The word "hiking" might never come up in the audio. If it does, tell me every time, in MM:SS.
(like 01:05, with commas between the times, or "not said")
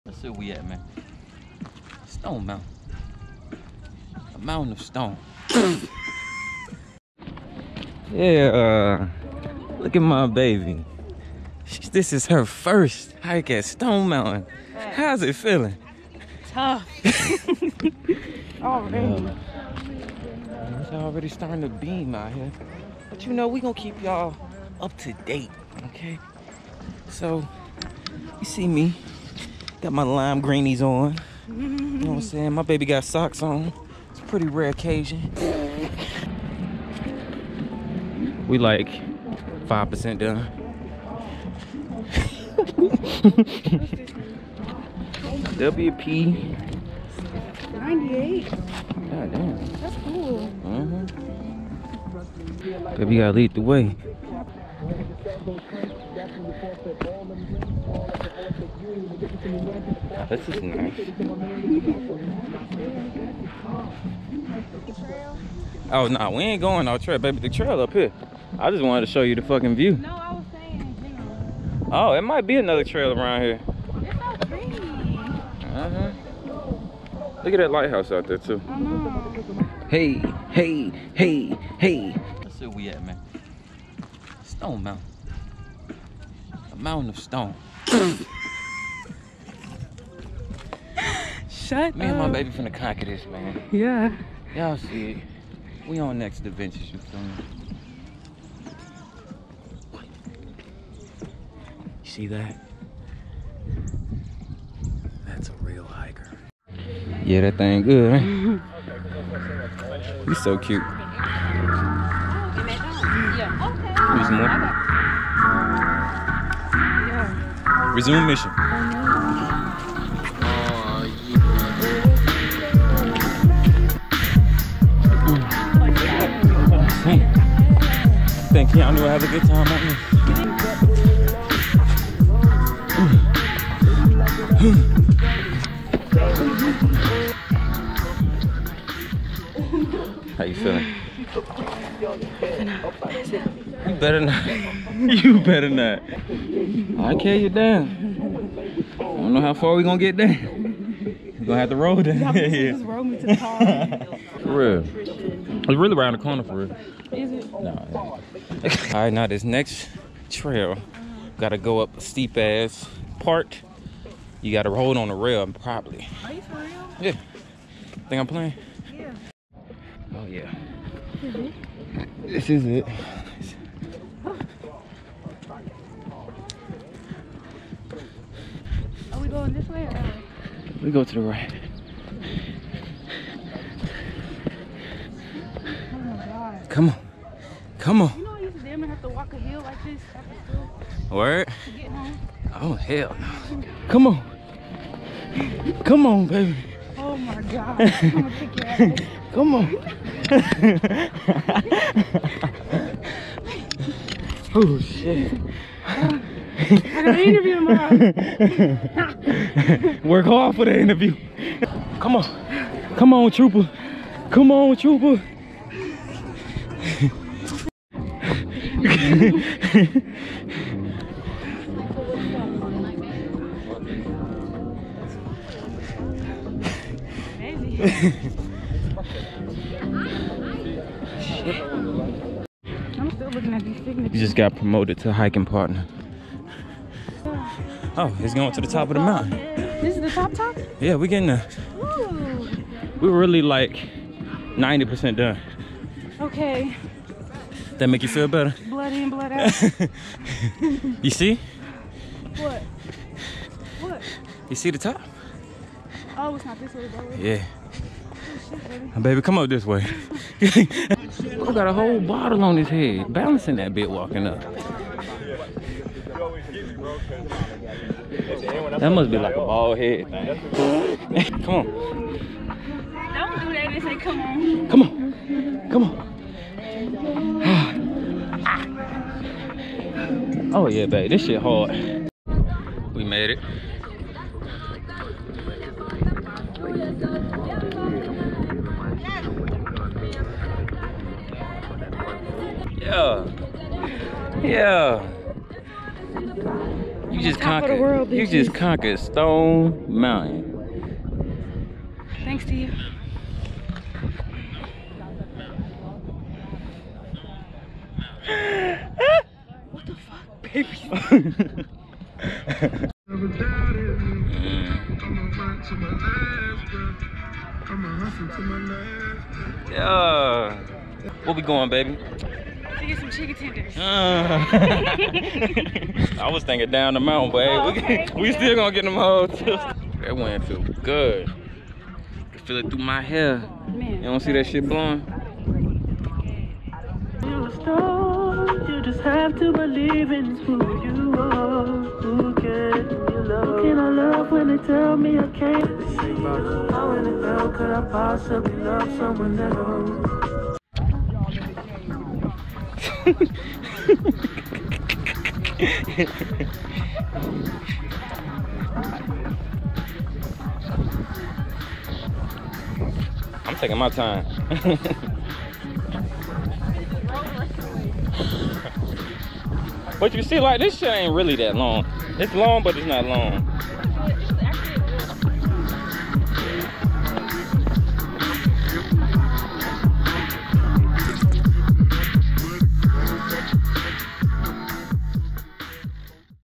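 03:55.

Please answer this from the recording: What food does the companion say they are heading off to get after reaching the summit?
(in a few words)
chicken tenders.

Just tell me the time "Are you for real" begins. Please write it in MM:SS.
02:46.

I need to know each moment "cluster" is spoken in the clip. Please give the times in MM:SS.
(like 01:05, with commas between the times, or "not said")
not said.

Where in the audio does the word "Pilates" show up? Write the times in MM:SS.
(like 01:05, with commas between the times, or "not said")
not said.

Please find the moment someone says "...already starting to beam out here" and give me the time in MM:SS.
00:20.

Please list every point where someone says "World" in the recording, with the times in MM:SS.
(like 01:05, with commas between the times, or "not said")
04:57.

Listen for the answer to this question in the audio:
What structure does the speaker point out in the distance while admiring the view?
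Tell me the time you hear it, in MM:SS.
01:17.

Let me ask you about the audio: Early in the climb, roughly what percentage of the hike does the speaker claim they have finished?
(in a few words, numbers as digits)
5%.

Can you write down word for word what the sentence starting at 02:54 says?
Are we going this way or We go to the right.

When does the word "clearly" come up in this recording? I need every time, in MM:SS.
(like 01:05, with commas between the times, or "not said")
not said.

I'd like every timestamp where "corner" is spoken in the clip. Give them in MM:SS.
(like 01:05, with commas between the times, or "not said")
02:36.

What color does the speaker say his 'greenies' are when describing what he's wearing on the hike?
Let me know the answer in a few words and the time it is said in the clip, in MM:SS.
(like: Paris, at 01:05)
lime, at 00:30.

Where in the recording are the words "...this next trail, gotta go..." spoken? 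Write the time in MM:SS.
02:39.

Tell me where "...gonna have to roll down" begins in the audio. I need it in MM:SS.
02:31.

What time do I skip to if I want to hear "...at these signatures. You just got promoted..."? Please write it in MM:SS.
03:53.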